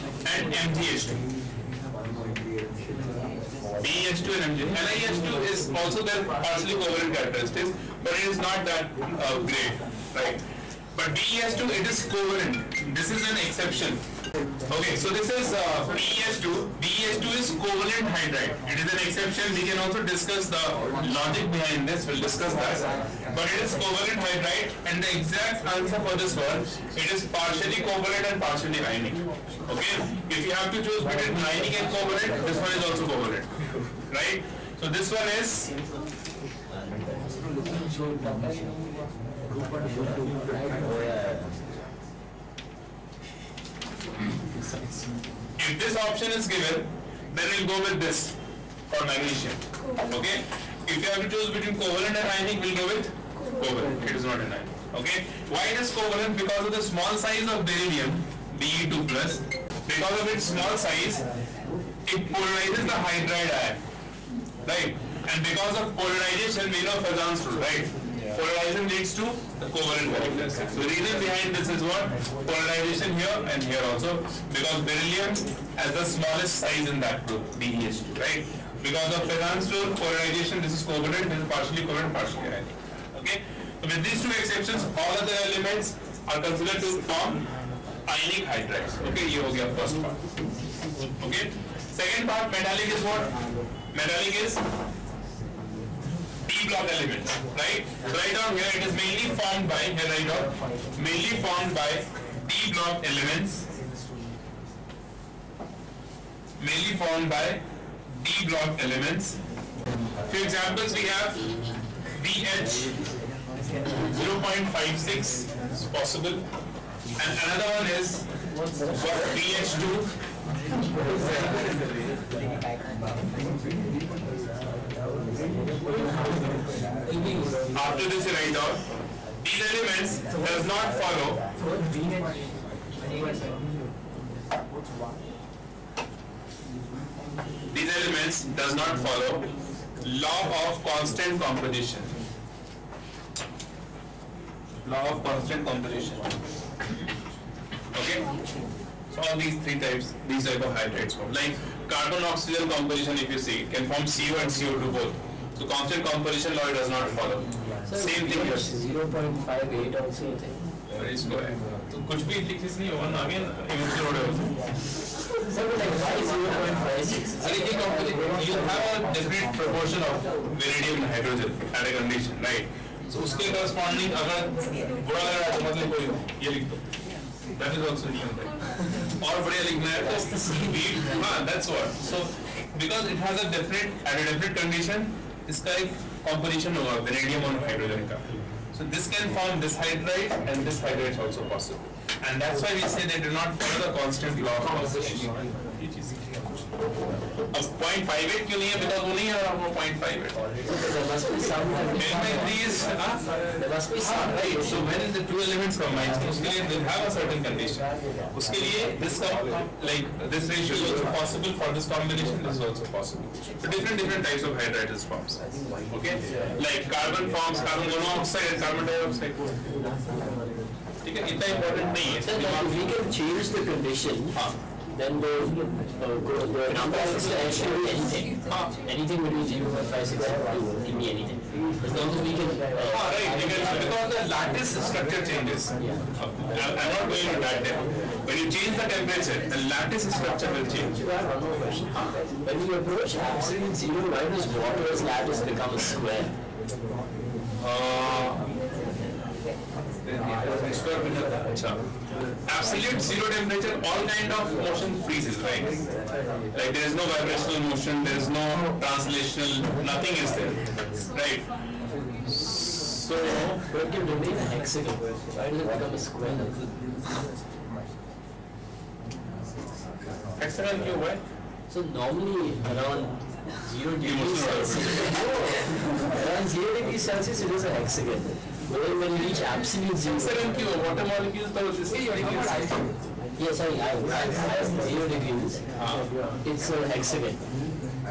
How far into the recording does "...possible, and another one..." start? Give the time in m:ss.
1:55.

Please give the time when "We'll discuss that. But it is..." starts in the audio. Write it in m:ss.
0:22.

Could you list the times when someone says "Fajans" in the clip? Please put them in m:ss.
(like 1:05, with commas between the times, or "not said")
1:07, 1:19.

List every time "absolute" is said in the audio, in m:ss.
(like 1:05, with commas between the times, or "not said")
4:03, 4:12, 4:39.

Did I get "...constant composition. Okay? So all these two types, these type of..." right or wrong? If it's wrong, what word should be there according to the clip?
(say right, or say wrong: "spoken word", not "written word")
wrong: "three", not "two".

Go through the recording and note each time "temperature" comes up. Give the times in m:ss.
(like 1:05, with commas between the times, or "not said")
3:58, 4:13.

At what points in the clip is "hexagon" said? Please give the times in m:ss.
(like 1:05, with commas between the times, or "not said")
4:24, 4:30, 4:37, 4:46.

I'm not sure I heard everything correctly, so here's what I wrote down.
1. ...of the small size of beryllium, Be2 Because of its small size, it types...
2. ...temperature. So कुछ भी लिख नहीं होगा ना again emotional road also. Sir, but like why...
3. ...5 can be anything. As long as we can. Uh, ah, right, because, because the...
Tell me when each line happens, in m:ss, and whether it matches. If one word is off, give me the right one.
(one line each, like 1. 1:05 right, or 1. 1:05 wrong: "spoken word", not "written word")
1. 0:56 wrong: "polarizes", not "types"
2. 2:41 wrong: "square", not "temperature"
3. 3:50 wrong: "2", not "5".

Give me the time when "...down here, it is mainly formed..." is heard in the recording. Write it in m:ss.
1:38.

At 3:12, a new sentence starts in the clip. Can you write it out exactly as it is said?
And that's why we say they do not follow the constant law of composition.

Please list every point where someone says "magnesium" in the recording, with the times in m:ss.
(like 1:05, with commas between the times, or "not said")
0:49.